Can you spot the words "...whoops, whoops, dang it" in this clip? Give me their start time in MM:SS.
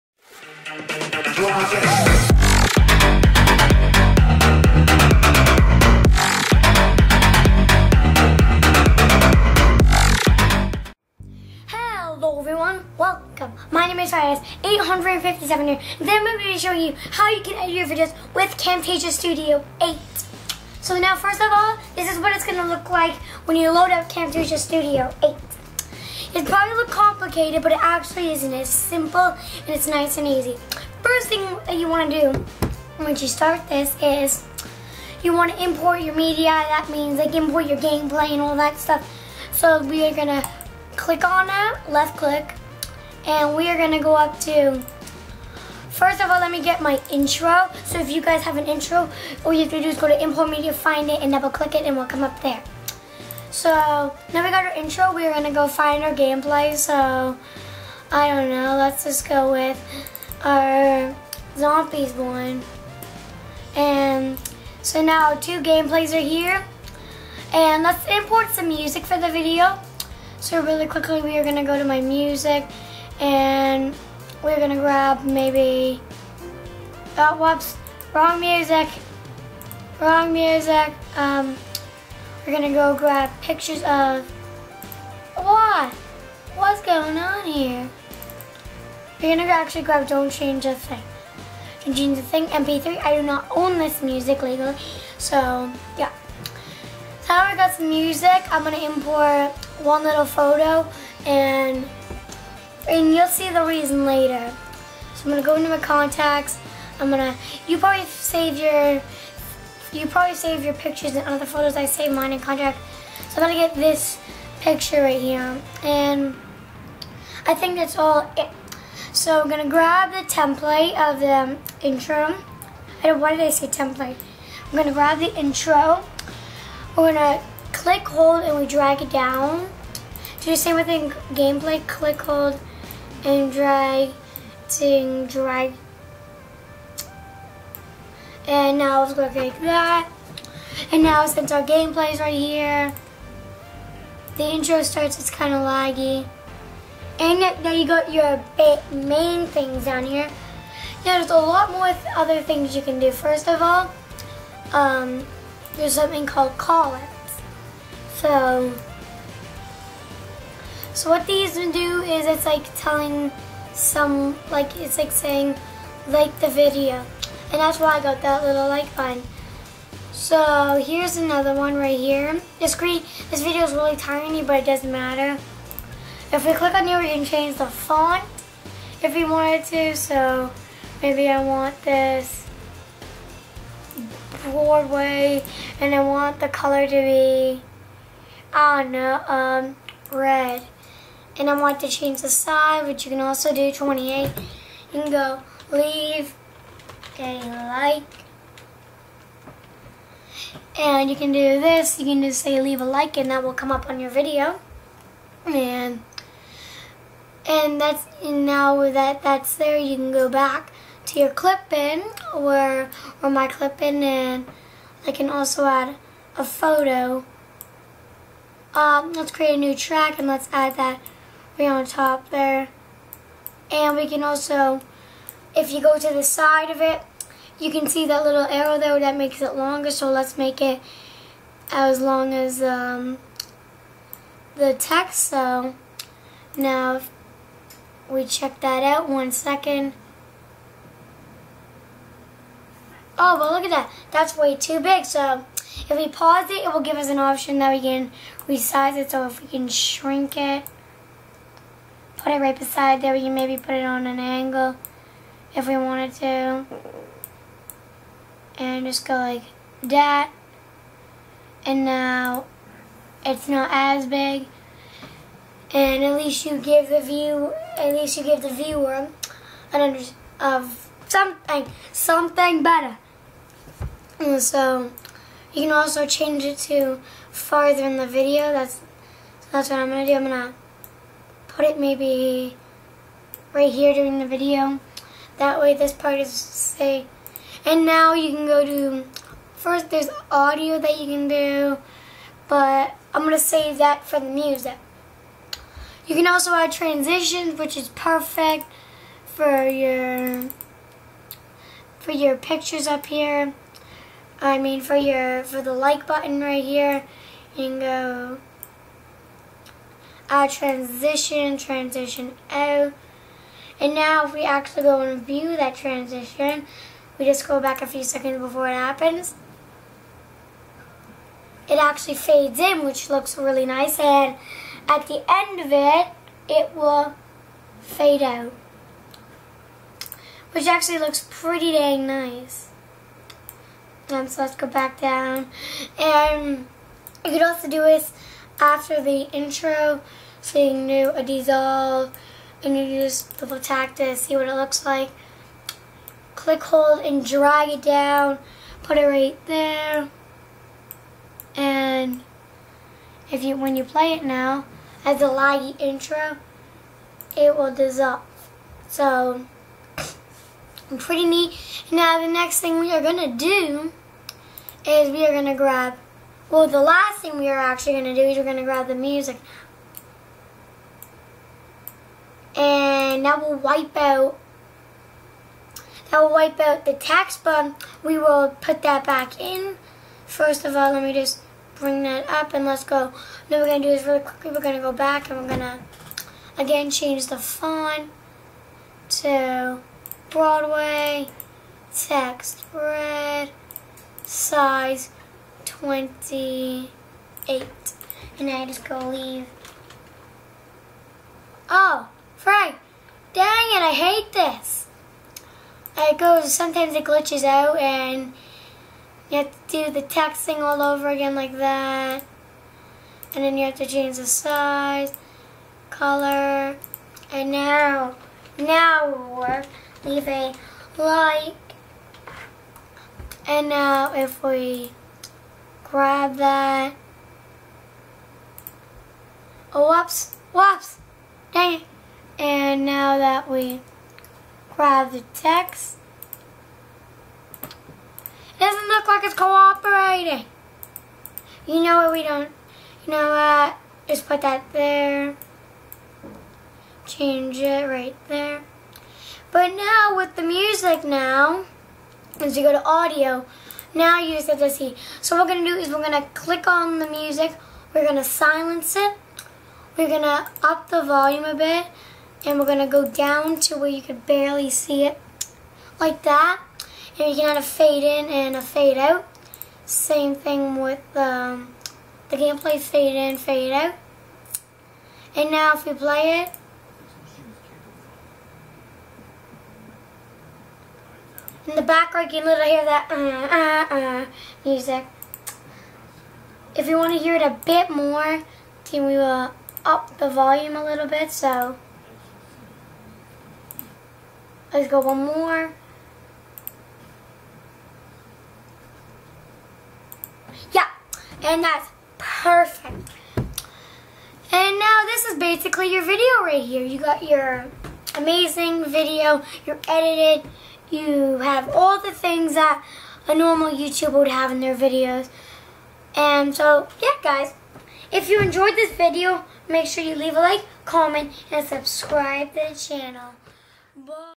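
07:09.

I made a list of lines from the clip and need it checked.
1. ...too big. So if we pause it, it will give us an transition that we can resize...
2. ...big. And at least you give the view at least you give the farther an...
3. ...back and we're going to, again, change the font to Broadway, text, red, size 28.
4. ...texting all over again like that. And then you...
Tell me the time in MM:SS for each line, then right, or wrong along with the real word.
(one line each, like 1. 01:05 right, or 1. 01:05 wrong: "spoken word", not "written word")
1. 04:04 wrong: "option", not "transition"
2. 04:24 wrong: "viewer", not "farther"
3. 06:24 right
4. 06:50 right.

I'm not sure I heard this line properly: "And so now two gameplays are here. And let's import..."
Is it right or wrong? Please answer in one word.
right.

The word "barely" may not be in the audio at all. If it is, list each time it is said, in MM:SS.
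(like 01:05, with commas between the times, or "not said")
07:44.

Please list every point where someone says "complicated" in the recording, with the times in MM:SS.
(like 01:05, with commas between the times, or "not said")
00:26.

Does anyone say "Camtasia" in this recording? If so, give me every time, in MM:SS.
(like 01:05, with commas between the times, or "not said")
00:18, 00:24.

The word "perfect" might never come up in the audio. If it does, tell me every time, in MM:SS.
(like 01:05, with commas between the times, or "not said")
04:57, 08:22.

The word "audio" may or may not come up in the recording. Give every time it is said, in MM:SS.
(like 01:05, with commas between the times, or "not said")
04:50, 07:32.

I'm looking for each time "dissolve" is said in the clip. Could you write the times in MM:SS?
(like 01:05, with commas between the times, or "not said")
05:41, 05:57.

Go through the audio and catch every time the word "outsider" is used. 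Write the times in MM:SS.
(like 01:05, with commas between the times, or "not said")
not said.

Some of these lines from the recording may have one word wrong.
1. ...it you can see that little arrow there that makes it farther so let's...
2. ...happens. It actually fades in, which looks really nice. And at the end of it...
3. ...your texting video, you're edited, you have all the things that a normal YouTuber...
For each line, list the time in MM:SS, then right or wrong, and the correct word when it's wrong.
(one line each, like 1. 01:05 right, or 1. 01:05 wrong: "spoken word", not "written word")
1. 03:46 wrong: "longer", not "farther"
2. 05:18 right
3. 08:27 wrong: "amazing", not "texting".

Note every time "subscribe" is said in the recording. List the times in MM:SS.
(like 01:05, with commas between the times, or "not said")
08:41.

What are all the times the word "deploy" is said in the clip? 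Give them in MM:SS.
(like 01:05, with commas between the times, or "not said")
not said.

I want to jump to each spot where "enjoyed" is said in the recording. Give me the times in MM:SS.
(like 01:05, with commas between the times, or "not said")
08:38.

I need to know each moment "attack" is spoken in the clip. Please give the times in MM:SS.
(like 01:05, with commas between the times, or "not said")
05:43.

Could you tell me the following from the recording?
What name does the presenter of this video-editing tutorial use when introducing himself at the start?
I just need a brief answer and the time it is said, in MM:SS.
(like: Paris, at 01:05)
Firedust, at 00:14.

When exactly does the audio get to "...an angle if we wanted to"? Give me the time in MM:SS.
04:14.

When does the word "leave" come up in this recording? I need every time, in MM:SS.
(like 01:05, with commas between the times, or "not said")
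03:15, 03:22, 06:39, 07:00, 08:40.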